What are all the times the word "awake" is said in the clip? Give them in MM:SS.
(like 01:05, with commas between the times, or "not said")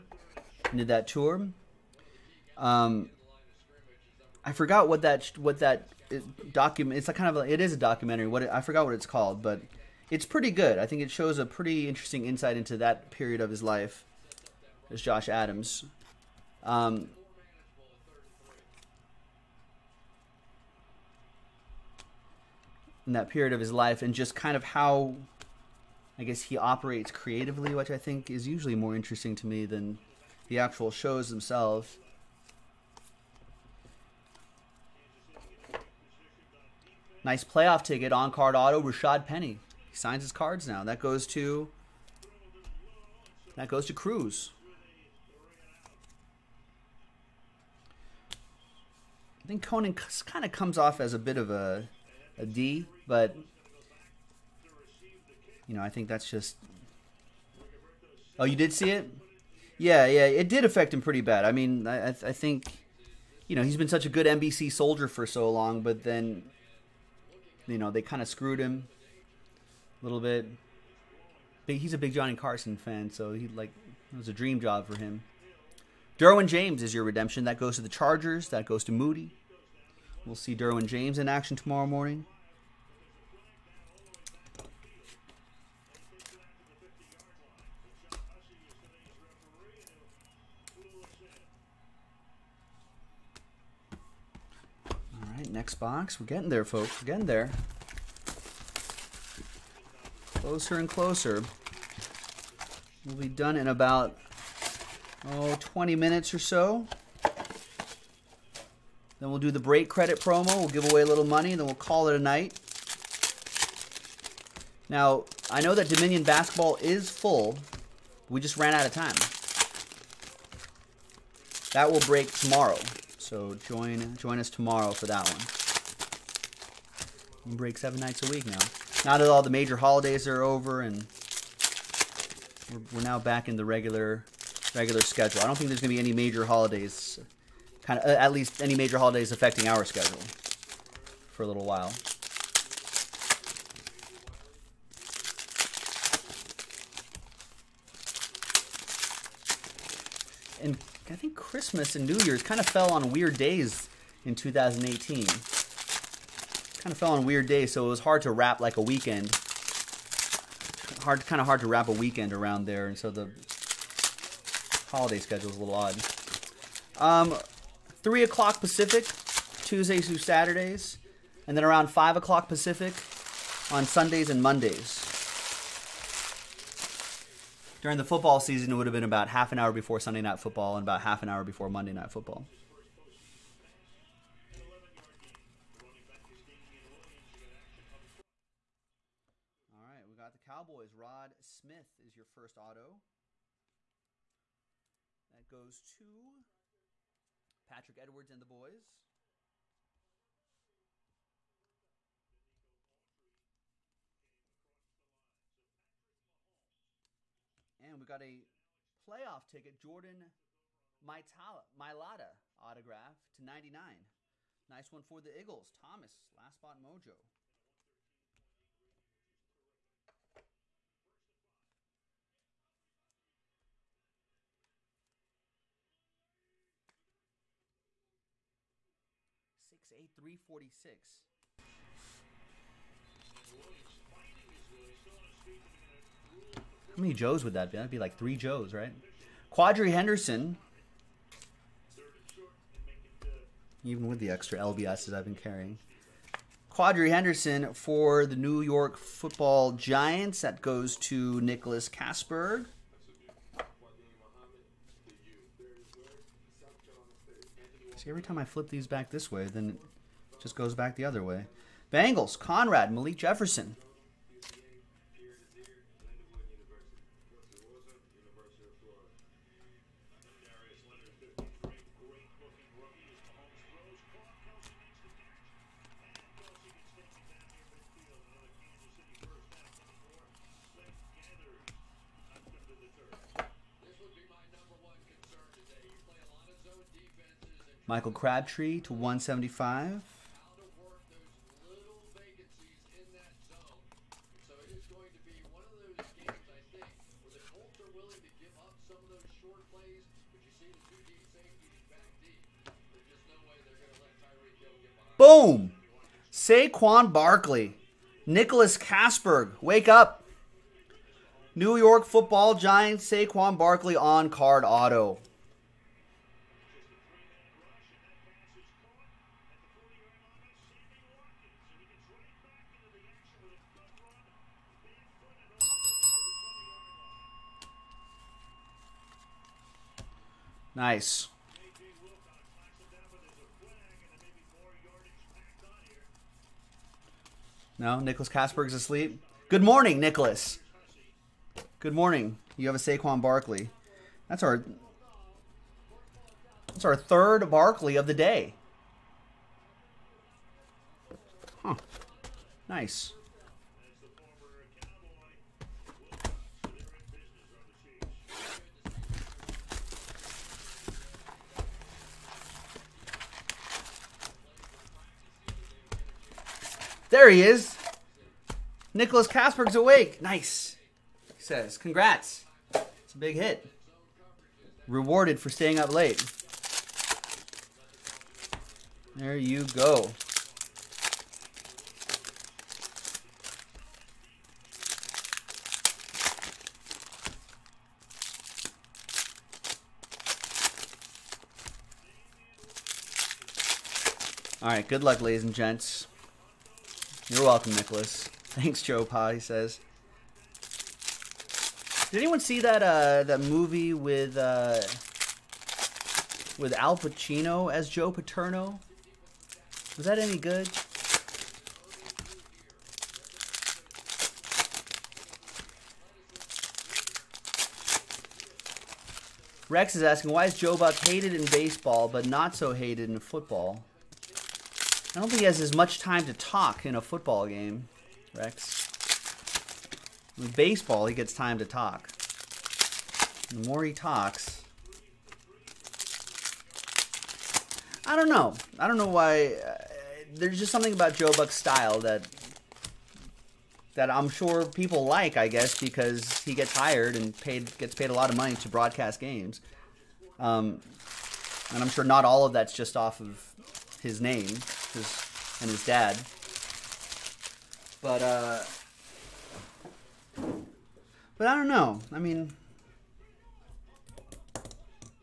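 06:09.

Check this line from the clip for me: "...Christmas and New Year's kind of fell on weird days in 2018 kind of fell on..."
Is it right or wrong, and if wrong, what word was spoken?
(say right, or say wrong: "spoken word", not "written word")
right.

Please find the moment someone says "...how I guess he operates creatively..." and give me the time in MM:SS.
00:24.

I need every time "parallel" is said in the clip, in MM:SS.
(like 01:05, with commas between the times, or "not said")
not said.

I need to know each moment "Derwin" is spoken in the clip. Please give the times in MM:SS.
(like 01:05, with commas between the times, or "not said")
01:16, 01:20.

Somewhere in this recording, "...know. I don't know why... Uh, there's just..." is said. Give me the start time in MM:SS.
07:18.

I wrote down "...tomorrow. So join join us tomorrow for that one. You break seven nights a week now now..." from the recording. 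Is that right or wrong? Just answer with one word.
right.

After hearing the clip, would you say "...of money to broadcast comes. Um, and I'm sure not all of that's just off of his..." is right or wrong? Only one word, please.
wrong.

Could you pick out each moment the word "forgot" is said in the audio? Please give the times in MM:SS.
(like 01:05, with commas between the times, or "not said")
00:04, 00:08.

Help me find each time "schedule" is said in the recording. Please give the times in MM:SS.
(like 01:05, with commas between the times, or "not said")
02:15, 02:19, 02:45.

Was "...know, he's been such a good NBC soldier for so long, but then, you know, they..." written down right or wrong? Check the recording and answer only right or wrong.
right.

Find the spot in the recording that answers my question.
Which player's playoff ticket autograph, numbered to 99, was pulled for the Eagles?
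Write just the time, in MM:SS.
03:29.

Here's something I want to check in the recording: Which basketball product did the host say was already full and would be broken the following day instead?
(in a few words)
Dominion.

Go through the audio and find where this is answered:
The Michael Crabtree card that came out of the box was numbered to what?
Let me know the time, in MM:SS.
04:48.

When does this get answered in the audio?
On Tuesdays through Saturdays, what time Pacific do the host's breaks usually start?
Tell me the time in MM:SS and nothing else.
02:48.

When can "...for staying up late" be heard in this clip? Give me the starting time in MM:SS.
06:15.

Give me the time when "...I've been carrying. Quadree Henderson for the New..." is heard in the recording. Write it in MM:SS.
04:05.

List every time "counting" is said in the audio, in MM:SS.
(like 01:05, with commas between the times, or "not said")
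not said.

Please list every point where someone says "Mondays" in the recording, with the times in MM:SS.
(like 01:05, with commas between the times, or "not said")
02:54, 03:01.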